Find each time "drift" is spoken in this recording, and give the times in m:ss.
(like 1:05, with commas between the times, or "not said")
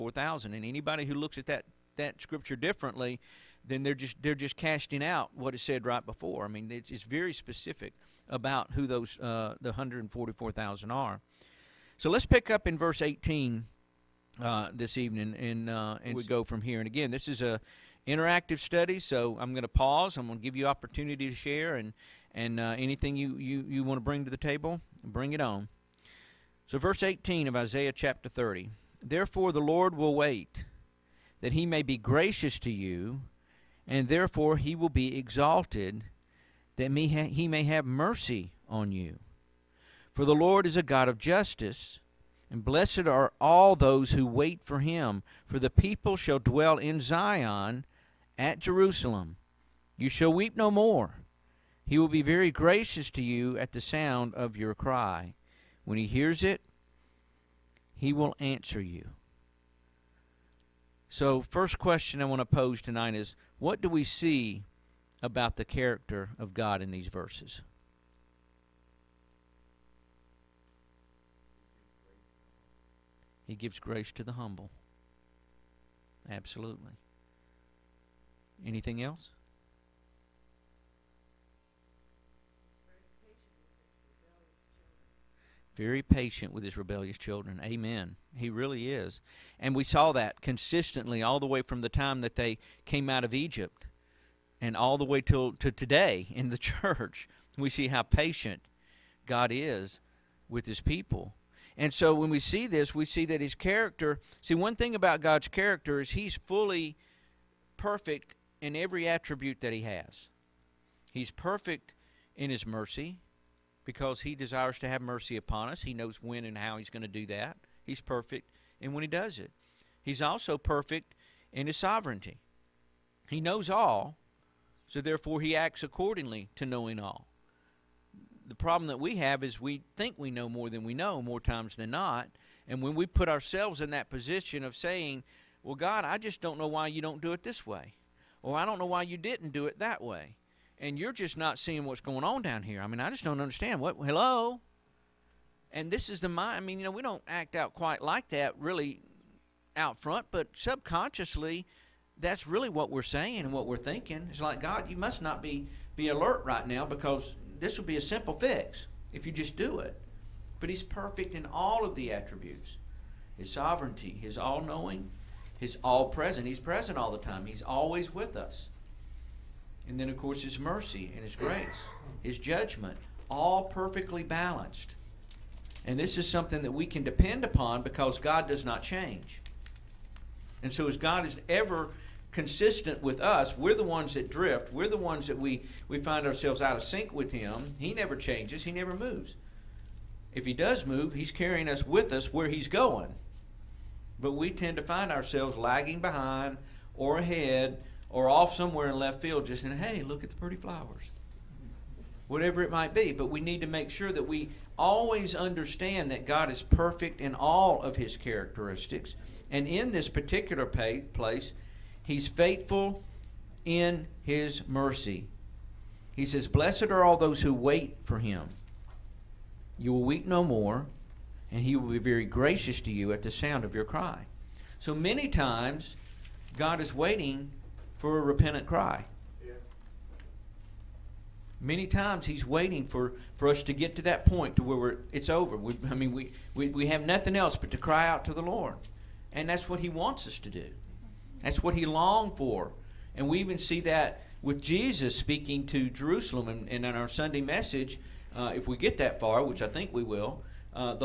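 3:04.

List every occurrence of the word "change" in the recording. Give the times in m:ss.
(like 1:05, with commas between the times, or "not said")
2:58, 3:08.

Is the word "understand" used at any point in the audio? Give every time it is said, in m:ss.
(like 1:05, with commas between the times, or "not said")
2:23, 3:25.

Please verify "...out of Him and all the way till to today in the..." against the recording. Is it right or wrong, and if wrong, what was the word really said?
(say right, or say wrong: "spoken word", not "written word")
wrong: "Egypt", not "Him".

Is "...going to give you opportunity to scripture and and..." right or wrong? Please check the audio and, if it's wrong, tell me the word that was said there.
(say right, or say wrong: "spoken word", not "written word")
wrong: "share", not "scripture".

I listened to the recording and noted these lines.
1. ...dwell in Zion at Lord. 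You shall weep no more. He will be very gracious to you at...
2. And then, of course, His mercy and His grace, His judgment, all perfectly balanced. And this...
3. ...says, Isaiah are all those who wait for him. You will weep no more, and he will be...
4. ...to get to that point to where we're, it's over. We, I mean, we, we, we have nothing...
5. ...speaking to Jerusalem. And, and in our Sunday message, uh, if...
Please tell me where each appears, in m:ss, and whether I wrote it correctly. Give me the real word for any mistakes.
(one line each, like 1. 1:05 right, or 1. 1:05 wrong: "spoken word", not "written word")
1. 0:46 wrong: "Jerusalem", not "Lord"
2. 2:49 right
3. 3:36 wrong: "Blessed", not "Isaiah"
4. 3:53 right
5. 4:05 right.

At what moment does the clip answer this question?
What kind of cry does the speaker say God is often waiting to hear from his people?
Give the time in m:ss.
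3:48.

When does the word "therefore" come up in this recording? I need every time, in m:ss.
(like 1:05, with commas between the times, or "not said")
0:29, 0:34, 2:05.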